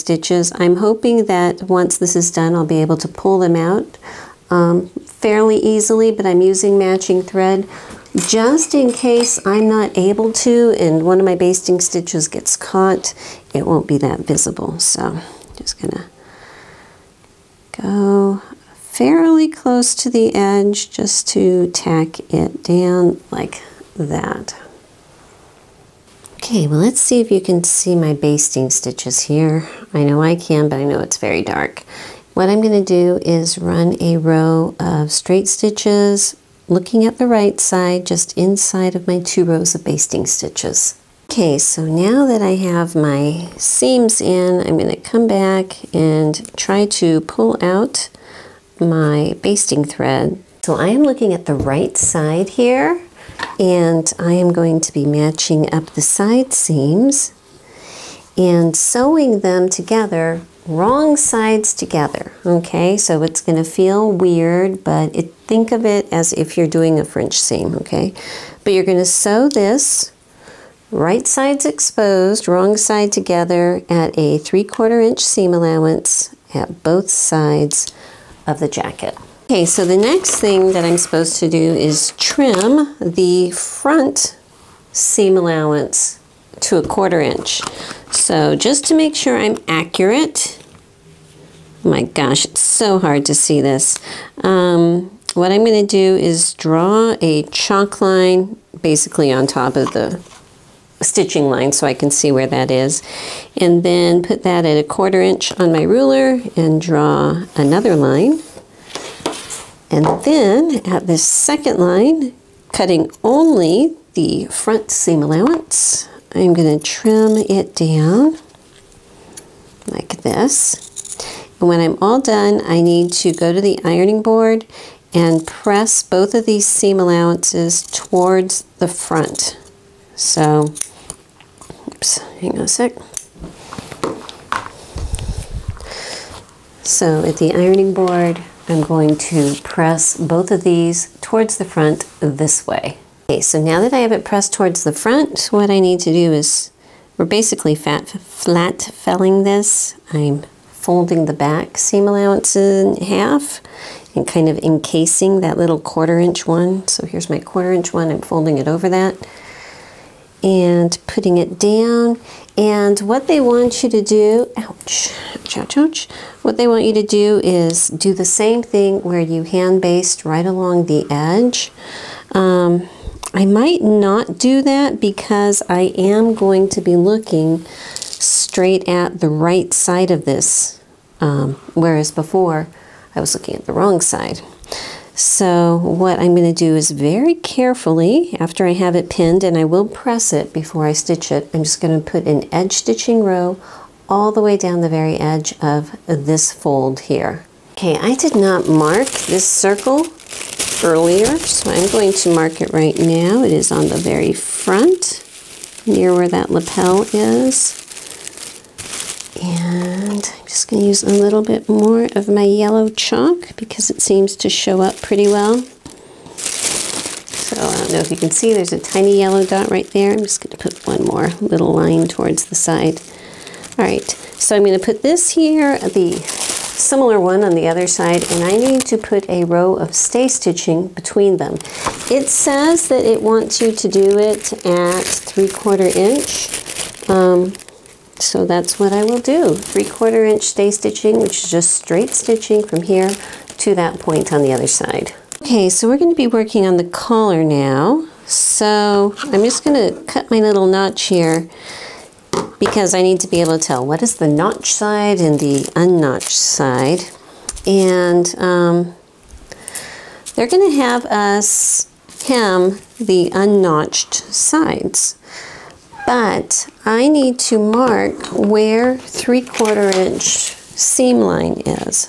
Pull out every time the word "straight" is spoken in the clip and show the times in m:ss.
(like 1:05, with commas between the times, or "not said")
0:35, 2:57, 4:01.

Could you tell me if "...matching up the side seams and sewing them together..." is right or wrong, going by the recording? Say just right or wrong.
right.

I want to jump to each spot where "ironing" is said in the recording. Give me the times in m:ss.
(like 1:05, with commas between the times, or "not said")
2:03, 2:17.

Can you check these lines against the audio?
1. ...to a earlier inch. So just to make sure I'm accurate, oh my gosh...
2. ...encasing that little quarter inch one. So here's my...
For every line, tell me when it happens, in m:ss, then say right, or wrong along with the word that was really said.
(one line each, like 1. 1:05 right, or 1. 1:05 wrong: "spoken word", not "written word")
1. 1:26 wrong: "quarter", not "earlier"
2. 2:34 right.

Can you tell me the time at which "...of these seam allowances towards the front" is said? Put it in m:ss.
2:06.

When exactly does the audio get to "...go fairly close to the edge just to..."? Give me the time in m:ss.
0:17.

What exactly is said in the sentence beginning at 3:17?
Okay, I did not mark this circle earlier, so I'm going to mark it right now.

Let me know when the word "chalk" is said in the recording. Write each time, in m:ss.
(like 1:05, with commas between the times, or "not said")
1:37, 3:32.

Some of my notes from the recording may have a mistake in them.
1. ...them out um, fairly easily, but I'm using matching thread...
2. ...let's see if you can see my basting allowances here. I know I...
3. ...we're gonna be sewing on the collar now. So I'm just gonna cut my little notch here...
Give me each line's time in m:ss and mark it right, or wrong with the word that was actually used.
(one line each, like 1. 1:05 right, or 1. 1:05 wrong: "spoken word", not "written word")
1. 0:03 right
2. 0:26 wrong: "stitches", not "allowances"
3. 4:05 wrong: "working", not "sewing".